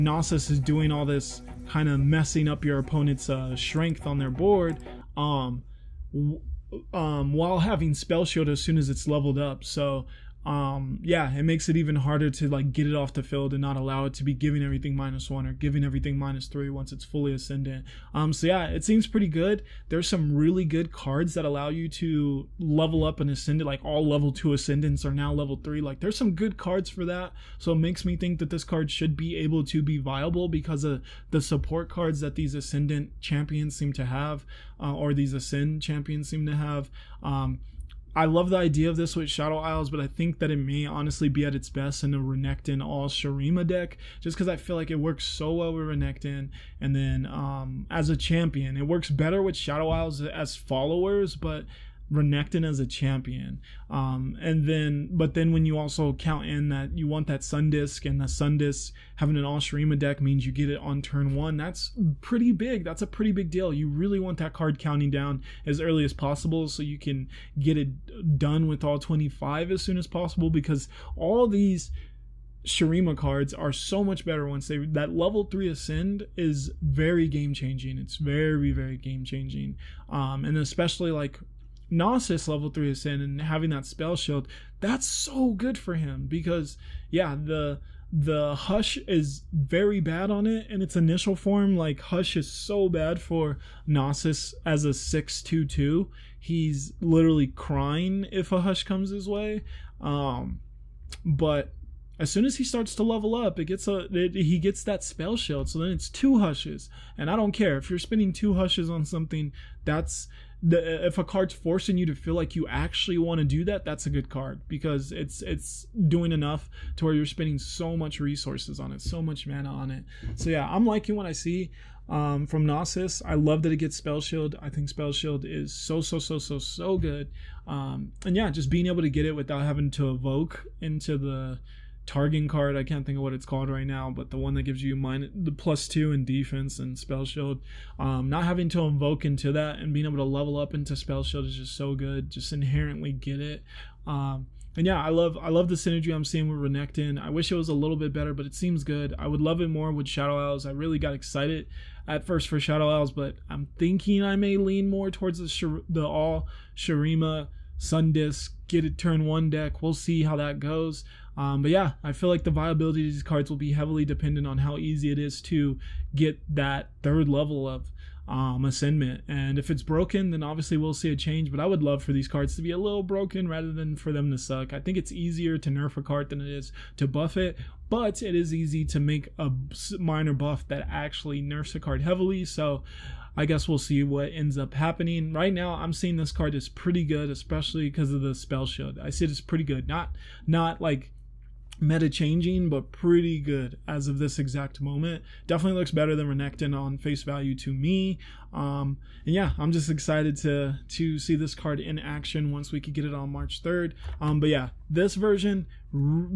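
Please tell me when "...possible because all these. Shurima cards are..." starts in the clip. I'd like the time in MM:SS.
01:10.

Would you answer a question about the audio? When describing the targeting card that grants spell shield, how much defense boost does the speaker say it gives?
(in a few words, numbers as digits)
plus two.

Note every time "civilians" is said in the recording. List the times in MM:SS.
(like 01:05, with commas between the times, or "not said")
not said.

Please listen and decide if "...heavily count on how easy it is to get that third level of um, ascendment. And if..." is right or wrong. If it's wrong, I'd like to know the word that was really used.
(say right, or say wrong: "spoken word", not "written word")
wrong: "dependent", not "count".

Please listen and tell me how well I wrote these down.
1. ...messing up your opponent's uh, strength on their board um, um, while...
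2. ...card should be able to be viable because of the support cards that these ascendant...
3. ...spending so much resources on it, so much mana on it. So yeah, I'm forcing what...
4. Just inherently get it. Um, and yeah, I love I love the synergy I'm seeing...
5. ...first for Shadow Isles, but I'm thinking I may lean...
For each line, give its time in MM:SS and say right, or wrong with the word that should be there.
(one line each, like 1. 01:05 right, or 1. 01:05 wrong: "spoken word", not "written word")
1. 00:01 right
2. 00:28 right
3. 01:57 wrong: "liking", not "forcing"
4. 02:22 right
5. 02:32 right.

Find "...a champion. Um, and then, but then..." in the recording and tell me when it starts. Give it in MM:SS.
00:52.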